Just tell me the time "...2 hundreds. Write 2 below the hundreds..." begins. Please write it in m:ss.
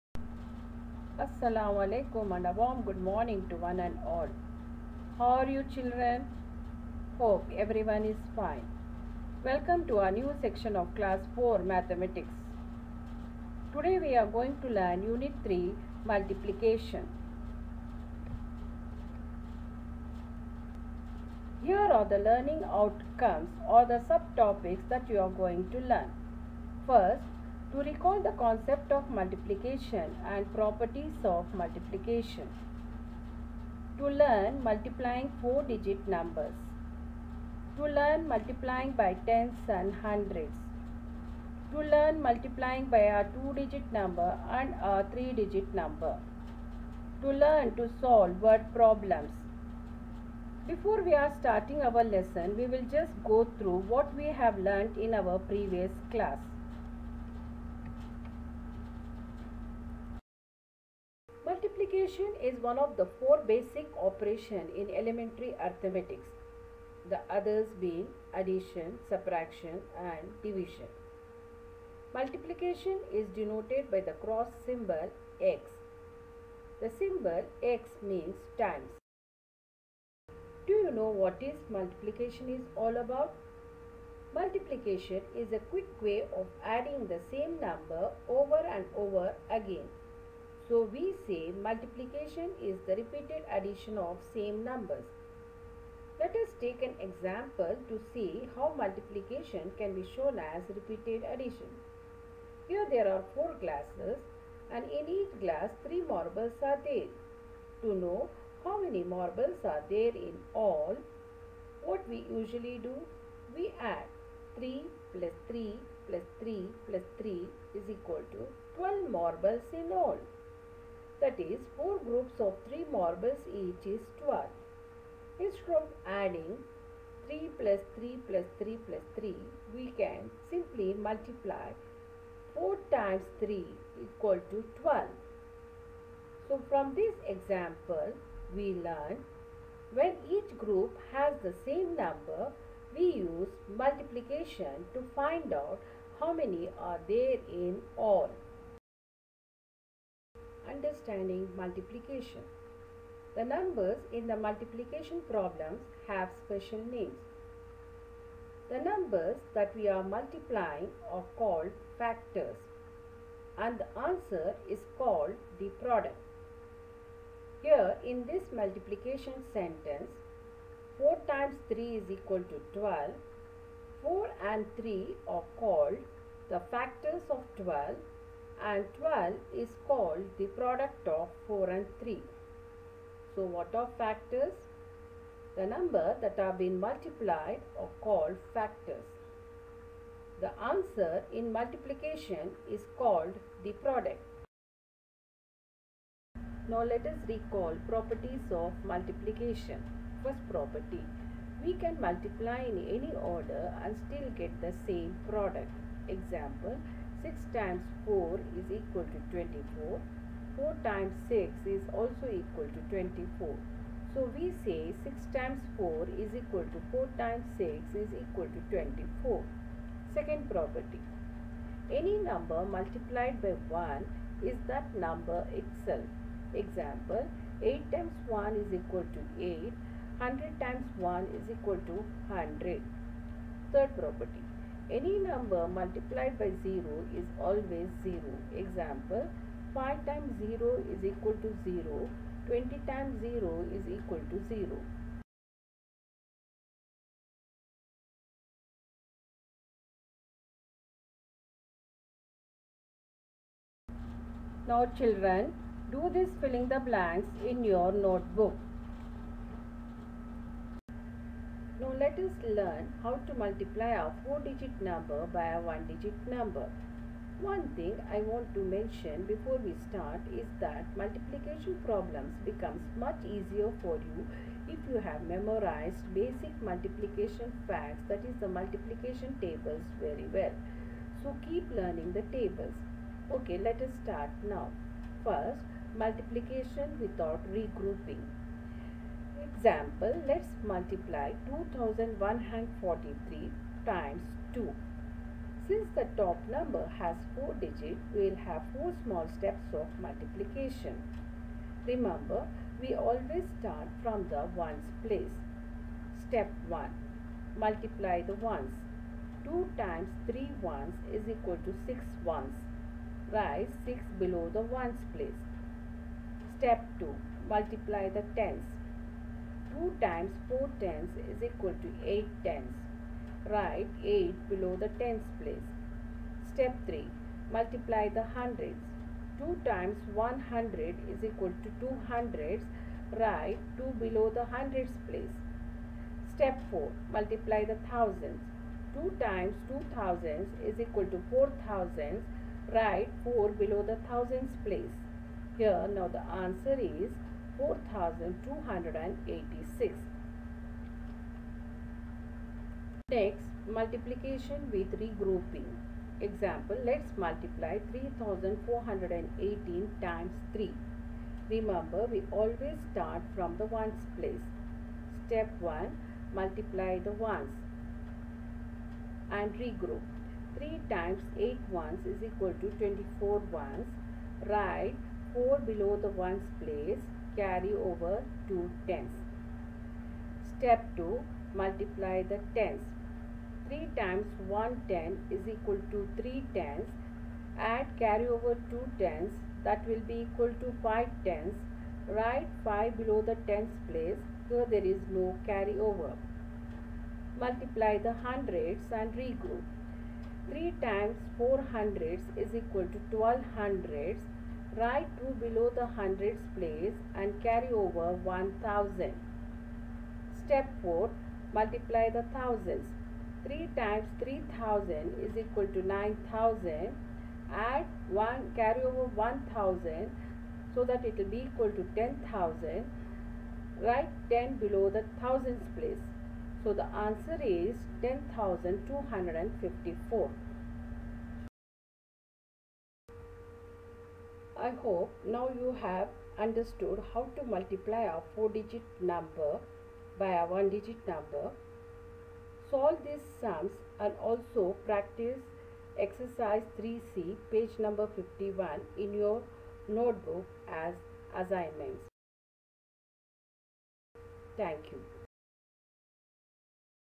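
5:31.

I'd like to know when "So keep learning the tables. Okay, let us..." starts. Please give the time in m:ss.
4:41.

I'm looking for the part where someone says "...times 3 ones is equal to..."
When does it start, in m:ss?
5:09.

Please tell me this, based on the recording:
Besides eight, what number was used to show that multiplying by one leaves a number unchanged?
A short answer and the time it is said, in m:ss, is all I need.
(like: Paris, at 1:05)
100, at 3:50.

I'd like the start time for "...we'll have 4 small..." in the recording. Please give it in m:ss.
4:58.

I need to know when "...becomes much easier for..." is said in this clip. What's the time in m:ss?
4:32.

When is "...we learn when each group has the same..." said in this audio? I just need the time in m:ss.
2:18.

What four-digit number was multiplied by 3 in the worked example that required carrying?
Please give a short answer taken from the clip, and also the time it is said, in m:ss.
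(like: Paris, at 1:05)
3418, at 5:57.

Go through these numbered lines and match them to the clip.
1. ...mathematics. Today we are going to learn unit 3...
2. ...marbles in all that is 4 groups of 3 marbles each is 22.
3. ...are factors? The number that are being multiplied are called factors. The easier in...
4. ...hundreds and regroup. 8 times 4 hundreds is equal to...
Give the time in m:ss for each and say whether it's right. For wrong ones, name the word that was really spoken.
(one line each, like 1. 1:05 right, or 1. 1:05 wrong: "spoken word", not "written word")
1. 0:11 right
2. 1:59 wrong: "12", not "22"
3. 3:03 wrong: "answer", not "easier"
4. 6:38 wrong: "3", not "8".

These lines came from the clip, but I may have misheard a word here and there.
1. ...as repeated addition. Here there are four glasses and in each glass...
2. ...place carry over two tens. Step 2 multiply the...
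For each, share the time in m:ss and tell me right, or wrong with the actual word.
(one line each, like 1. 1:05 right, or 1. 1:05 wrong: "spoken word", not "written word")
1. 1:40 right
2. 6:16 right.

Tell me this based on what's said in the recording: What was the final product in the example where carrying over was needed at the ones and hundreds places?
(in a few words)
10,254.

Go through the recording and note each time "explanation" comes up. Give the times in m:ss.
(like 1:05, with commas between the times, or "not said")
not said.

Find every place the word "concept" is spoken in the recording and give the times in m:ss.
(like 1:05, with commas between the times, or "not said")
0:28.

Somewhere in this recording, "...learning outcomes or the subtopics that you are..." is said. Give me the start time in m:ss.
0:22.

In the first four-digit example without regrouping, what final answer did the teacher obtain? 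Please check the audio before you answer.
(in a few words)
4286.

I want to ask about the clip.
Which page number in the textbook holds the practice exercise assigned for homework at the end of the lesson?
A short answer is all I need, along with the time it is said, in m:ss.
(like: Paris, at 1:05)
51, at 7:27.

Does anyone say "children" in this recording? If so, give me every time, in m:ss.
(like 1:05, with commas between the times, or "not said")
0:05, 4:14.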